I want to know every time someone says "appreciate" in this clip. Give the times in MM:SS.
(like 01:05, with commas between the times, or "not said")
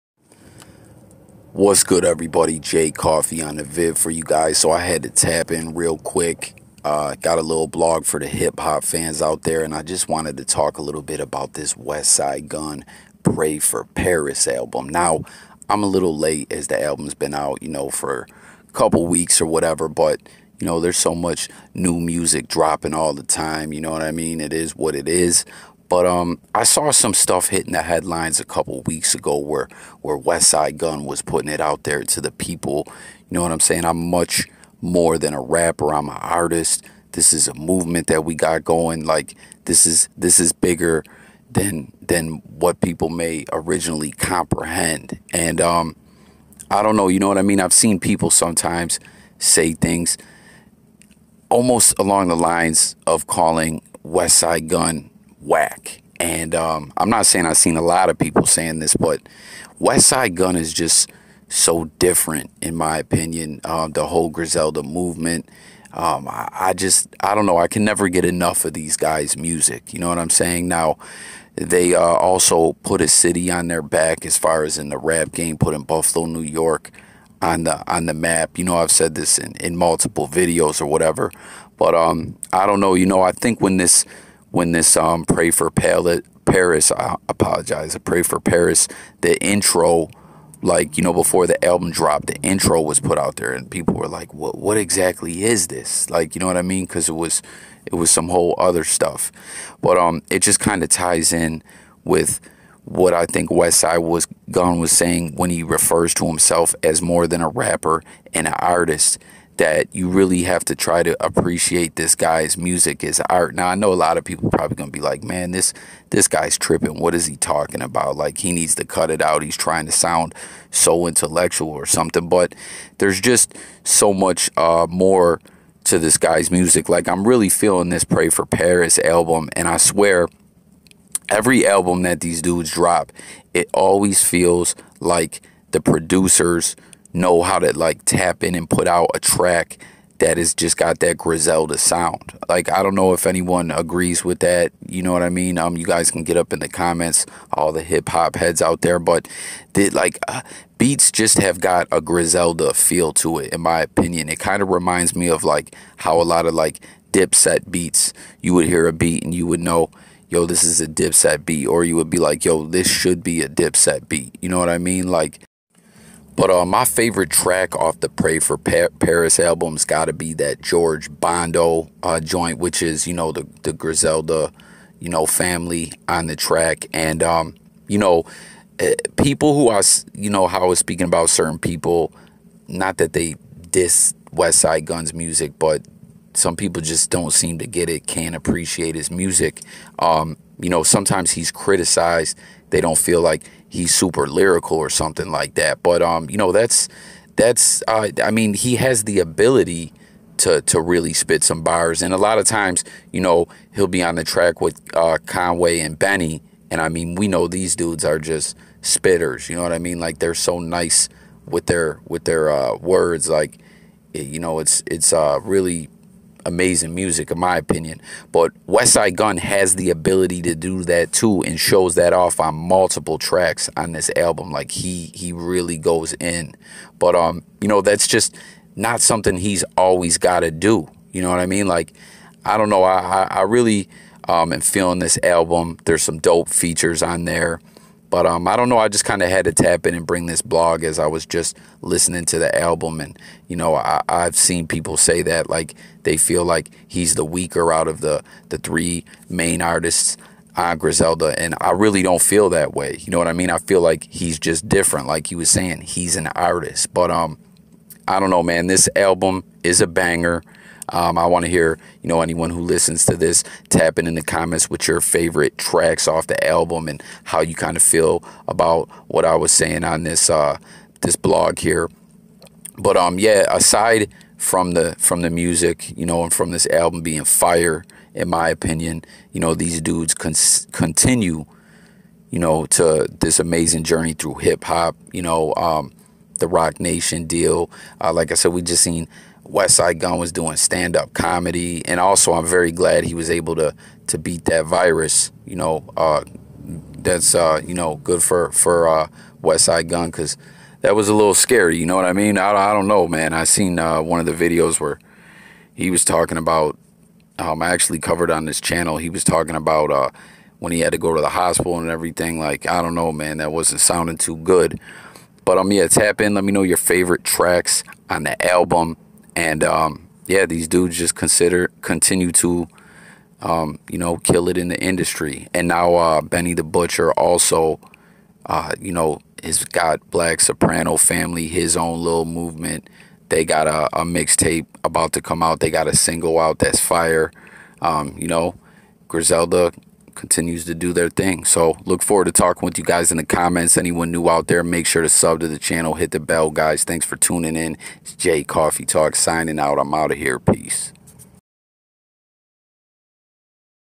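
01:51, 03:08.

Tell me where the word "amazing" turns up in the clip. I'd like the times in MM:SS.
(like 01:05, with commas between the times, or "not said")
03:36, 04:43.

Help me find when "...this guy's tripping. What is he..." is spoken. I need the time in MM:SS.
01:56.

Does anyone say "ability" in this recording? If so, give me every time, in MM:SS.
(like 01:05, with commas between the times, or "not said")
03:19, 03:39.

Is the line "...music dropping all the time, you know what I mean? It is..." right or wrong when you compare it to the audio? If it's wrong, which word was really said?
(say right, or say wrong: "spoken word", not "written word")
right.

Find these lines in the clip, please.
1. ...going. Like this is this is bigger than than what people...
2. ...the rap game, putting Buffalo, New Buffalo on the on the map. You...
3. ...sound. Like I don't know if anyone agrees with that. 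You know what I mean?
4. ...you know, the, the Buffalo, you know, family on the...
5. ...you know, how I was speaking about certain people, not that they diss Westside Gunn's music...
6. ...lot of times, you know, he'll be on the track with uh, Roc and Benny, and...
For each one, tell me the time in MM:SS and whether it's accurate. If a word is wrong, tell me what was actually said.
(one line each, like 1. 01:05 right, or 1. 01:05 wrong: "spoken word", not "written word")
1. 00:38 right
2. 01:14 wrong: "York", not "Buffalo"
3. 02:21 right
4. 02:53 wrong: "Griselda", not "Buffalo"
5. 03:00 right
6. 03:22 wrong: "Conway", not "Roc".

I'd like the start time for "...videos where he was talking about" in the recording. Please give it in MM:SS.
05:04.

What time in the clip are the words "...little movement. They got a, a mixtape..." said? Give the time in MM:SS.
05:32.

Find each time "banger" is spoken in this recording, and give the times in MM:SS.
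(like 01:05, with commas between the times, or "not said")
04:19.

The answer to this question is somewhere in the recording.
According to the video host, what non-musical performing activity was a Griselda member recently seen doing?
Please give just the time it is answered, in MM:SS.
04:50.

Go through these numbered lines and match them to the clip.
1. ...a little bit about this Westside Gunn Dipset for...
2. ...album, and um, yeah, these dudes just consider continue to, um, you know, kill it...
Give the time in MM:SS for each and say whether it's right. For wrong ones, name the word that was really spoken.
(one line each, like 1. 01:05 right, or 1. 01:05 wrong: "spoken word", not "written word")
1. 00:10 wrong: "Pray", not "Dipset"
2. 05:18 right.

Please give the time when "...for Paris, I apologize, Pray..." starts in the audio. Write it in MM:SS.
01:25.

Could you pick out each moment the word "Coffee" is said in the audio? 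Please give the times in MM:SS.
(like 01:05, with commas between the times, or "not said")
00:02, 05:48.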